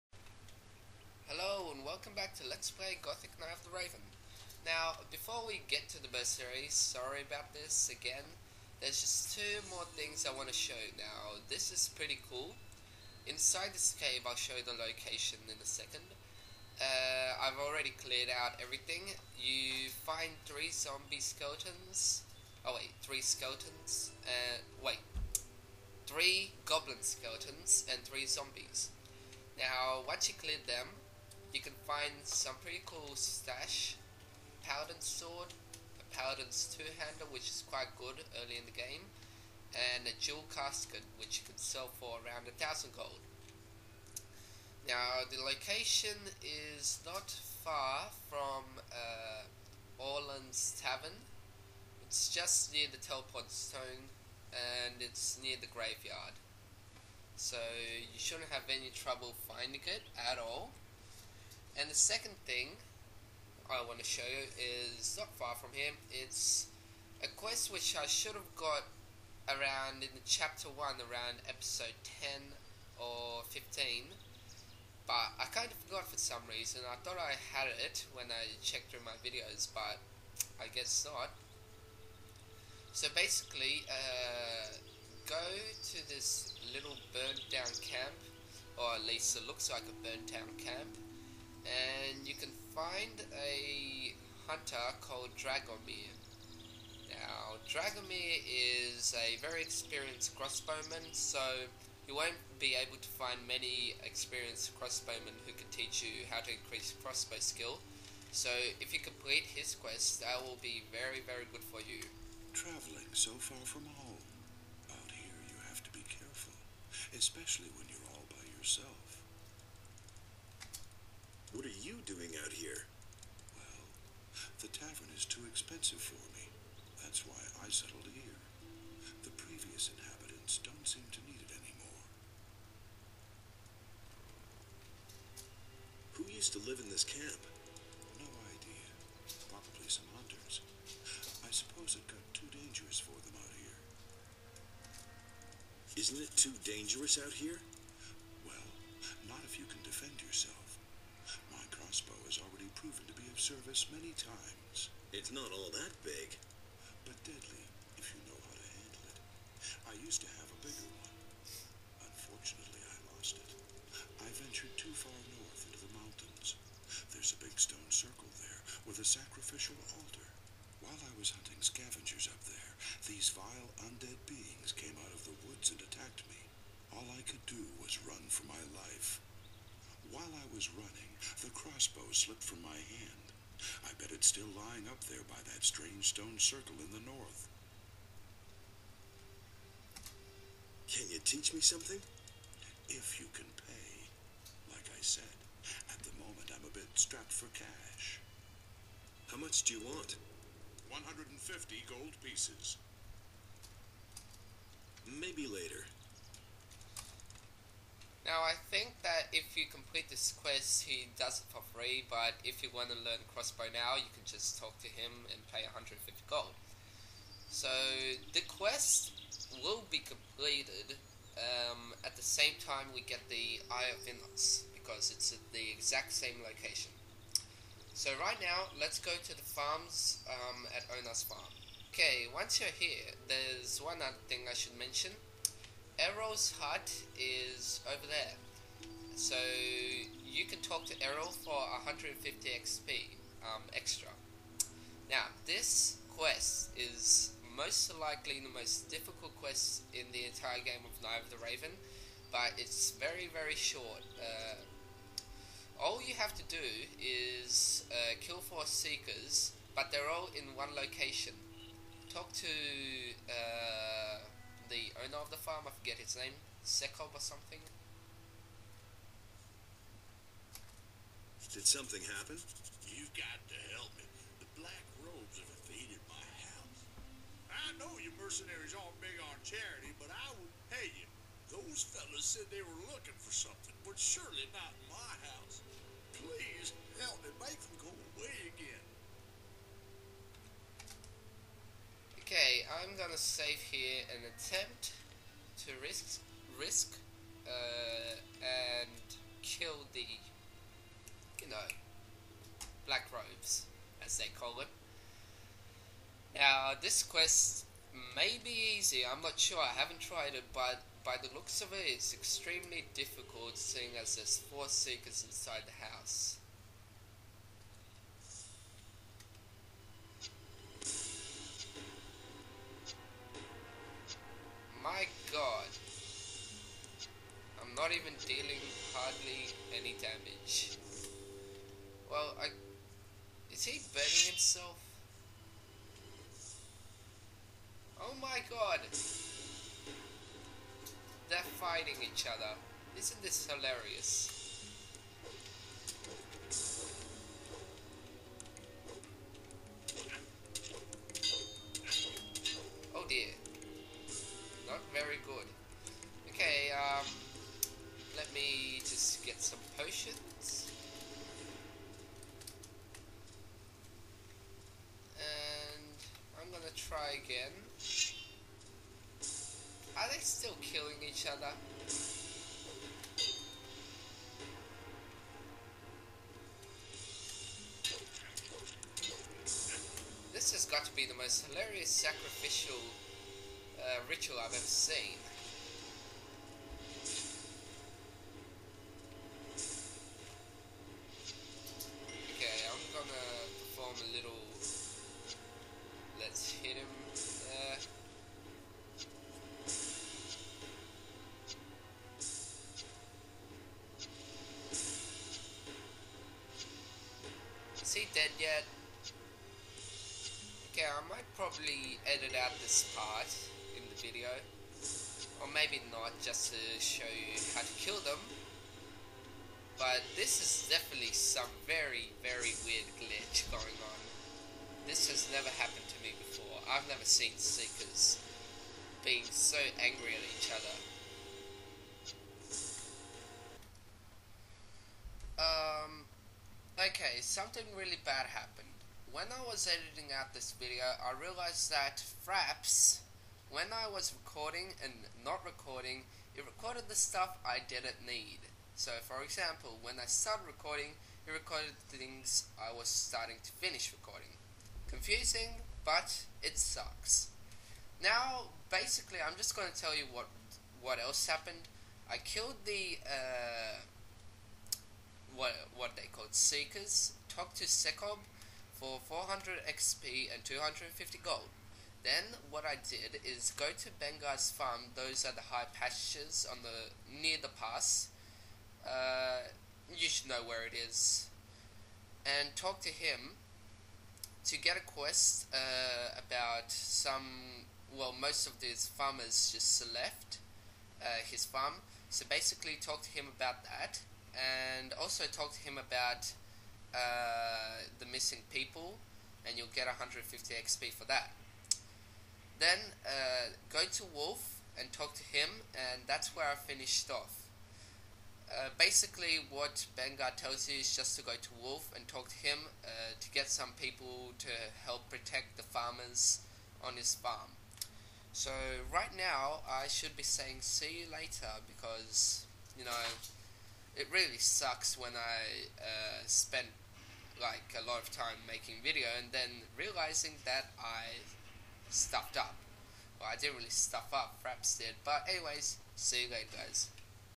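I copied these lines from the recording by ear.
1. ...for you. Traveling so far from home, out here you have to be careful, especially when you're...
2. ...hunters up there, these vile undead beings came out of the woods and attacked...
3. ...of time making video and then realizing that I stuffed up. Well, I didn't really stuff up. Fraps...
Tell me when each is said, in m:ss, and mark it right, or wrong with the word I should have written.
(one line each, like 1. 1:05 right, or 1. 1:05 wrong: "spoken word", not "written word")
1. 1:51 right
2. 2:51 wrong: "scavengers", not "hunters"
3. 8:48 right.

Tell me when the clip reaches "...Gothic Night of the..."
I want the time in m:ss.
0:02.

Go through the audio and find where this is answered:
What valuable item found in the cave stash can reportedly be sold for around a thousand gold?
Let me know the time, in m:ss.
0:40.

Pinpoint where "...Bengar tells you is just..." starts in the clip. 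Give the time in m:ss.
8:29.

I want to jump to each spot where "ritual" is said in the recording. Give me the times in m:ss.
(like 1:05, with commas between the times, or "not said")
6:24.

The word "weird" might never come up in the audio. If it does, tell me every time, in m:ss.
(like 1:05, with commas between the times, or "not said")
7:02.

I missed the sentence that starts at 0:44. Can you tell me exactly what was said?
Now the location is not far from uh, Orlan's Tavern.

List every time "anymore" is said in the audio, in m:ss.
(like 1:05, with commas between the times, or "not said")
2:11.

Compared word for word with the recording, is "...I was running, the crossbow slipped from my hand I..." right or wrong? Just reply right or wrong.
right.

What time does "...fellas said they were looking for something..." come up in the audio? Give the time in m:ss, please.
4:41.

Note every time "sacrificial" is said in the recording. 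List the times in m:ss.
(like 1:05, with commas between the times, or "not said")
2:49, 6:21.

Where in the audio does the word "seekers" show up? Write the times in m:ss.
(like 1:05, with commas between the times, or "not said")
4:18, 5:14, 7:07, 7:46.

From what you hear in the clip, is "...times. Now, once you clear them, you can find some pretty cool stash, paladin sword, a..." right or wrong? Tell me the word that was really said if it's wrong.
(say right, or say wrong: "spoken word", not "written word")
wrong: "zombies", not "times".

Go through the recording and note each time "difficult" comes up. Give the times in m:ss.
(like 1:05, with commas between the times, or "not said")
4:08, 5:12.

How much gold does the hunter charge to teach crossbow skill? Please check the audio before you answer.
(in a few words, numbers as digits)
150 gold pieces.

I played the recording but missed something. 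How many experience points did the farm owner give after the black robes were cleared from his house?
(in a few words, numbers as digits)
400.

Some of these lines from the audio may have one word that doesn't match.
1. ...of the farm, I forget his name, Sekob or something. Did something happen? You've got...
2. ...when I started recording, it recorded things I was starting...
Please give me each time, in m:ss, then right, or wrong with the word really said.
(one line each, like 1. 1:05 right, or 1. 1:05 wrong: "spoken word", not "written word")
1. 4:25 right
2. 7:29 right.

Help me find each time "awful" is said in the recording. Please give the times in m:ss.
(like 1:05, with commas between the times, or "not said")
not said.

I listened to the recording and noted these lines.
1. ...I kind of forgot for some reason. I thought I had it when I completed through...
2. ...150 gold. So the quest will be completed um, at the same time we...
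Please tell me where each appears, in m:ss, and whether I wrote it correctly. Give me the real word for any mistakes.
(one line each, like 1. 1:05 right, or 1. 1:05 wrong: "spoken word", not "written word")
1. 1:15 wrong: "checked", not "completed"
2. 3:35 right.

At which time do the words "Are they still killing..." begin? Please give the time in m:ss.
6:09.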